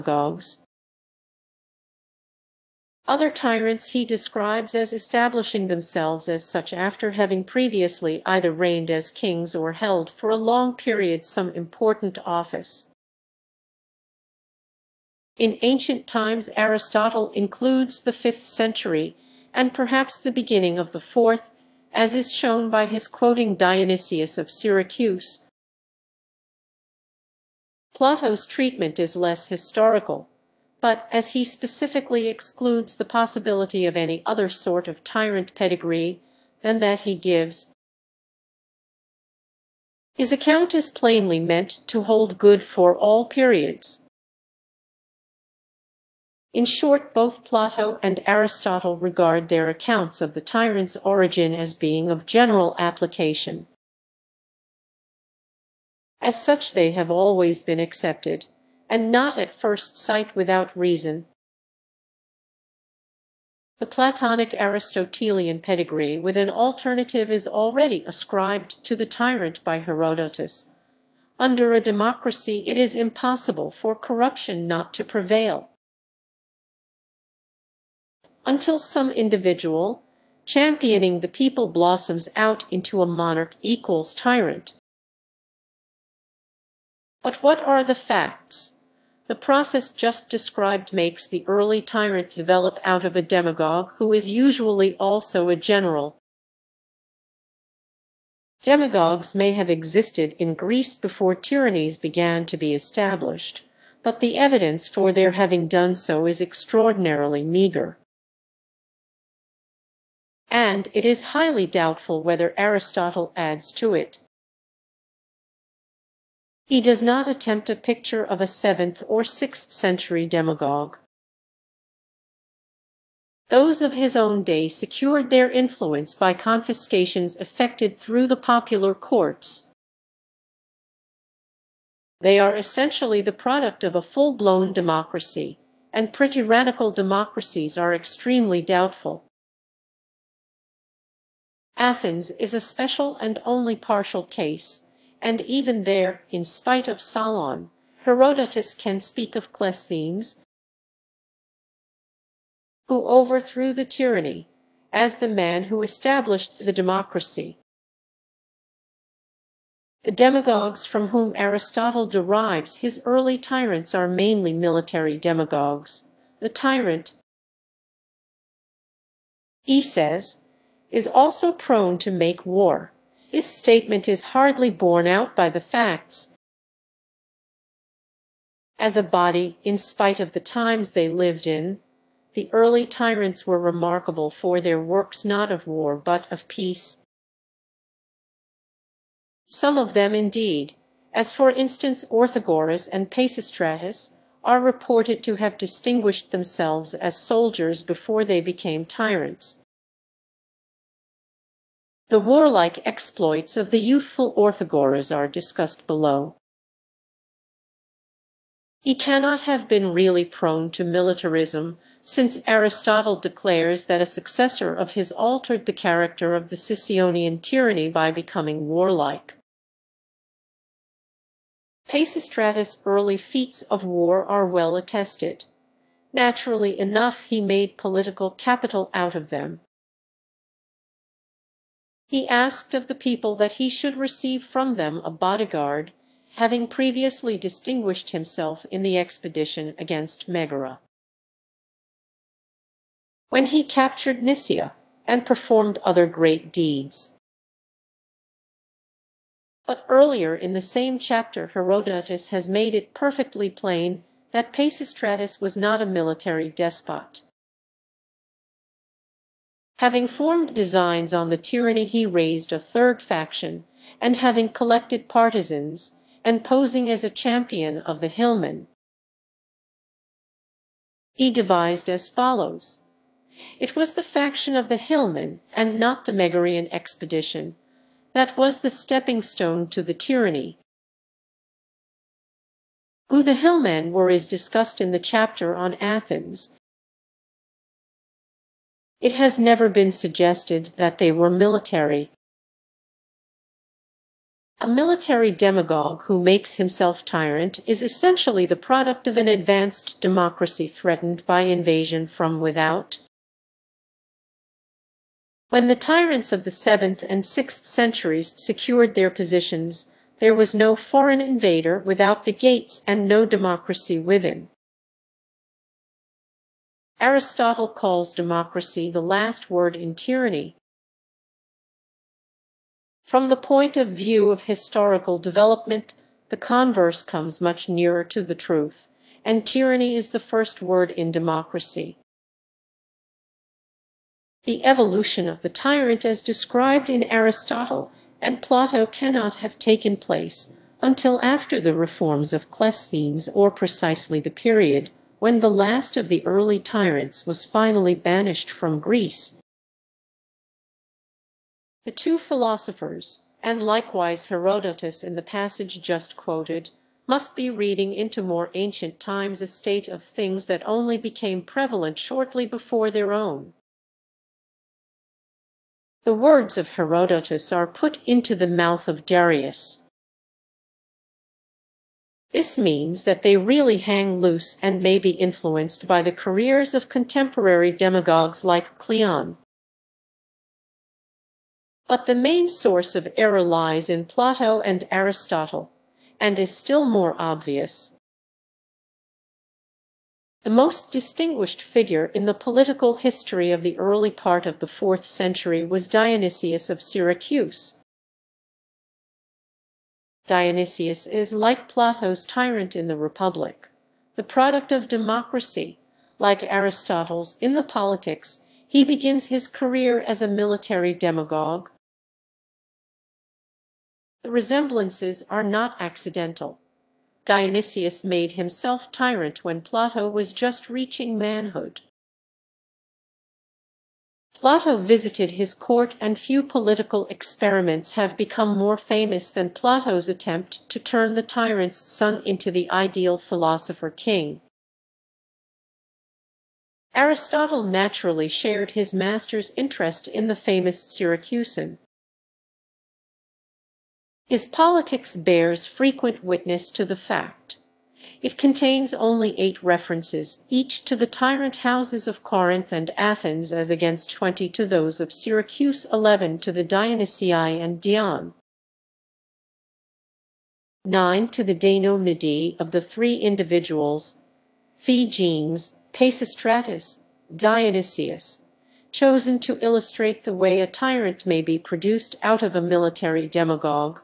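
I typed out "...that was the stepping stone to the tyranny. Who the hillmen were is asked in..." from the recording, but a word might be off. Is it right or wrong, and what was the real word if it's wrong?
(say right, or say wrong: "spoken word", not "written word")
wrong: "discussed", not "asked".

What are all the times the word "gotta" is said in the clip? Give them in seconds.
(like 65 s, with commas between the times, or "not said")
not said.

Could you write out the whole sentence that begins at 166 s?
The tyrant, he says, is also prone to make war.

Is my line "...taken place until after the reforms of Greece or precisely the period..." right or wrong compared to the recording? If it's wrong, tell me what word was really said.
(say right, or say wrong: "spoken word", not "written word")
wrong: "Cleisthenes", not "Greece".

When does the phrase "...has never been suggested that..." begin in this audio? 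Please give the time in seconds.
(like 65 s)
289 s.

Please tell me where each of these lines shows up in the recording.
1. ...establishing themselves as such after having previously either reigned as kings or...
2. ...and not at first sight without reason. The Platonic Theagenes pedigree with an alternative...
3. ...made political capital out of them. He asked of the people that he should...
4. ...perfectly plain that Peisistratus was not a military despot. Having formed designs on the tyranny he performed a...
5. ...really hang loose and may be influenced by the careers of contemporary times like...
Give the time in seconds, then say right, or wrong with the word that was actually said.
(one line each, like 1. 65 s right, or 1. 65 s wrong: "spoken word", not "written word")
1. 4 s right
2. 58 s wrong: "Aristotelian", not "Theagenes"
3. 227 s right
4. 252 s wrong: "raised", not "performed"
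5. 373 s wrong: "demagogues", not "times".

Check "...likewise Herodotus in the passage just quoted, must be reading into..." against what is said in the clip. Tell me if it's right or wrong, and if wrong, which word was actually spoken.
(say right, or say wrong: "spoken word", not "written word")
right.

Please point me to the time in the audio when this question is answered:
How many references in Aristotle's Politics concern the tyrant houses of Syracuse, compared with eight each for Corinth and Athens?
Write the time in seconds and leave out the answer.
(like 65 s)
454 s.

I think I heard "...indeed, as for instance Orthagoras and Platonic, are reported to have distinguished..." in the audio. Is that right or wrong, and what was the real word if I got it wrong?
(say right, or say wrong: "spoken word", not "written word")
wrong: "Peisistratus", not "Platonic".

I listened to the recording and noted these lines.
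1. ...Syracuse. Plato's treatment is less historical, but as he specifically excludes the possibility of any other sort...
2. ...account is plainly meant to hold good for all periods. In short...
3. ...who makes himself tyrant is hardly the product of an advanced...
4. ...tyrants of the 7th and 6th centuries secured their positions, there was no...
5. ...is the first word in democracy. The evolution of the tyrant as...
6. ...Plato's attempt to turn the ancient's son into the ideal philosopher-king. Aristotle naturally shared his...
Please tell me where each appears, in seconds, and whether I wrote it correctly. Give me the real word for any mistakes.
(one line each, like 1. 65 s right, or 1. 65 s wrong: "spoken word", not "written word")
1. 24 s right
2. 40 s right
3. 296 s wrong: "essentially", not "hardly"
4. 305 s right
5. 329 s right
6. 429 s wrong: "tyrant", not "ancient".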